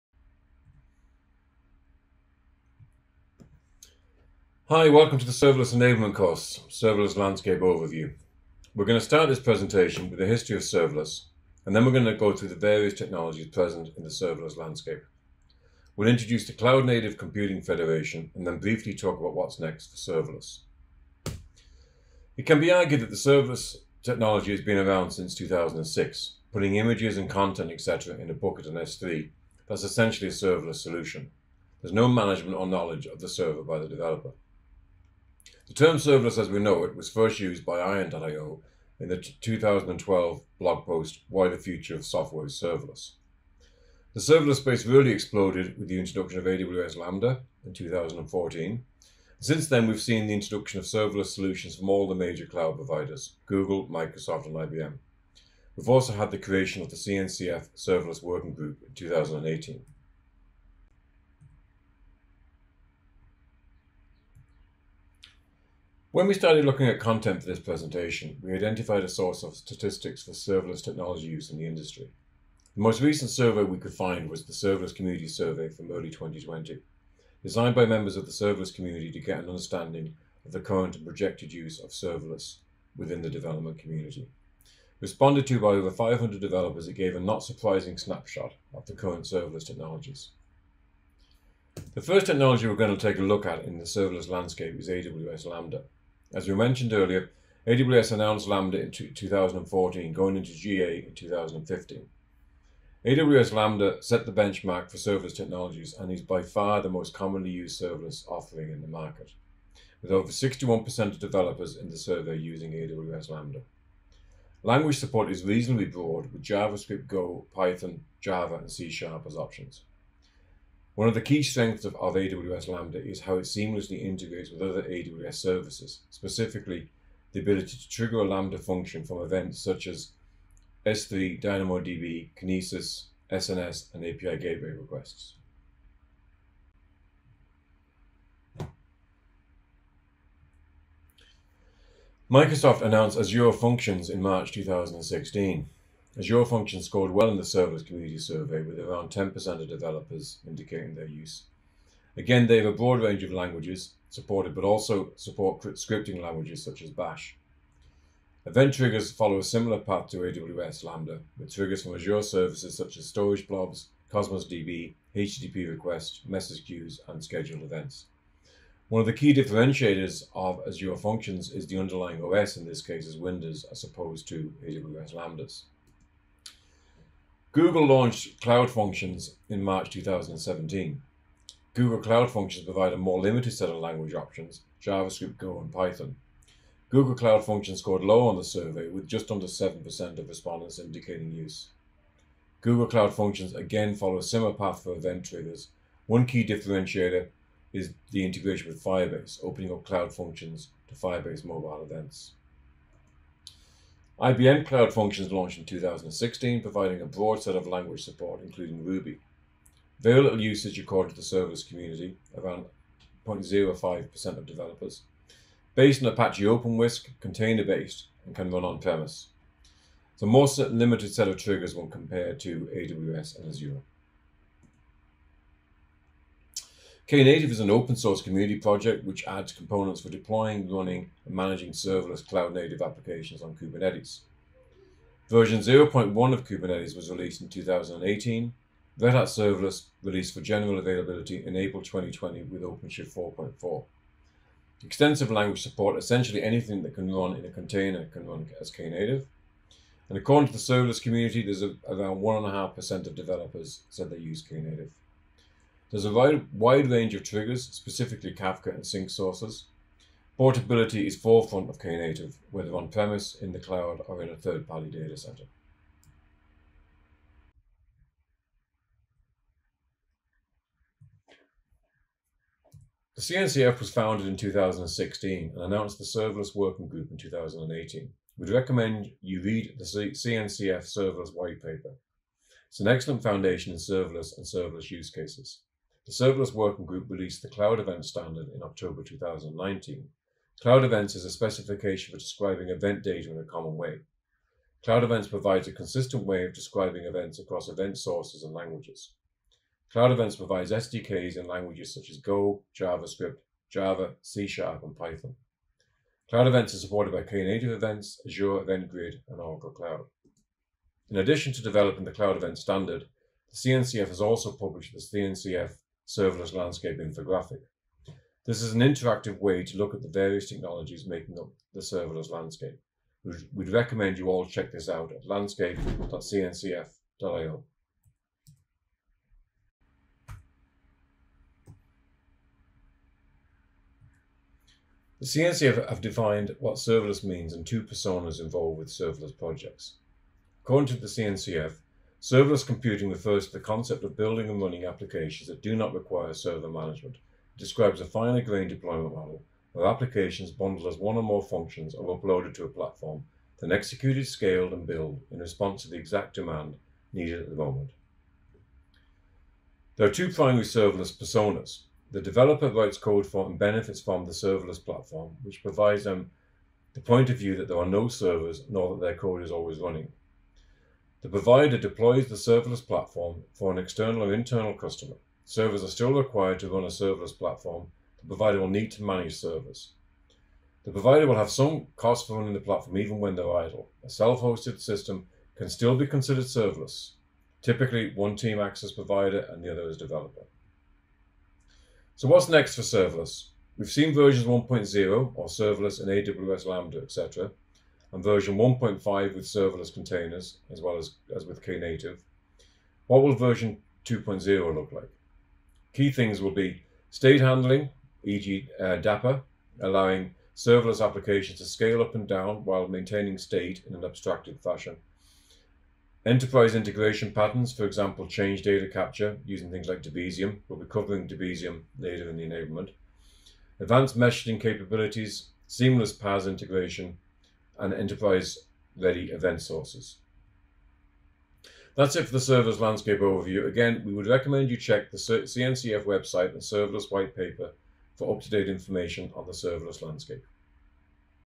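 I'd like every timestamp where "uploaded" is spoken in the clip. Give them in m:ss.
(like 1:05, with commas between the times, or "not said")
5:52.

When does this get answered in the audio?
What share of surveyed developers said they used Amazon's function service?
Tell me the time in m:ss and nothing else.
1:50.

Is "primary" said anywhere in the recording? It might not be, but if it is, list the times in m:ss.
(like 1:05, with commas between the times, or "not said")
6:00.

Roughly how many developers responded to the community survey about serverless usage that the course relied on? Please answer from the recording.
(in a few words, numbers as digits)
over 500.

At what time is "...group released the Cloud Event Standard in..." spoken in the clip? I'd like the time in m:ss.
4:46.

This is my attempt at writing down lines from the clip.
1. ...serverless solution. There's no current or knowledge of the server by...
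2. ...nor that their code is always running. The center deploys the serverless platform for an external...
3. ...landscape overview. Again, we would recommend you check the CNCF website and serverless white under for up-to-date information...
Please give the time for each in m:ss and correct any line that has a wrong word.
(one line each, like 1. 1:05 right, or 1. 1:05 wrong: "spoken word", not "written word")
1. 0:30 wrong: "management", not "current"
2. 6:08 wrong: "provider", not "center"
3. 7:12 wrong: "paper", not "under".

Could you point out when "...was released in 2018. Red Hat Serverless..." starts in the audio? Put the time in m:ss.
3:56.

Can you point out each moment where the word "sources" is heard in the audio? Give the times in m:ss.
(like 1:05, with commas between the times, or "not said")
1:09, 3:47, 4:19, 4:57, 7:09.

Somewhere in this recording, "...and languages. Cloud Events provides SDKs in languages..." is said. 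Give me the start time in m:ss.
4:58.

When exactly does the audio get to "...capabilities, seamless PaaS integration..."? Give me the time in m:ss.
7:04.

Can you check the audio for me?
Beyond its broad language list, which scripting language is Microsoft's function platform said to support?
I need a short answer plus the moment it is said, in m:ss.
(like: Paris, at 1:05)
Bash, at 2:36.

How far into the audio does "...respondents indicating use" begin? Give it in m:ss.
3:10.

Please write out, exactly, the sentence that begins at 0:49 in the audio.
Since then, we've seen the introduction of serverless solutions from all the major cloud providers Google, Microsoft, and IBM.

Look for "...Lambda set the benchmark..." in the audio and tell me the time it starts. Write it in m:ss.
1:43.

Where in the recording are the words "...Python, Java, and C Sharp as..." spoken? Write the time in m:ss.
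1:57.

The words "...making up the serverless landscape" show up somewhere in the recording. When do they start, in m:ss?
5:21.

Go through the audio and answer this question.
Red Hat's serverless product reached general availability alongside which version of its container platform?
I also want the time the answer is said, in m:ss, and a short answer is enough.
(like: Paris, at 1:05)
OpenShift 4.4, at 4:02.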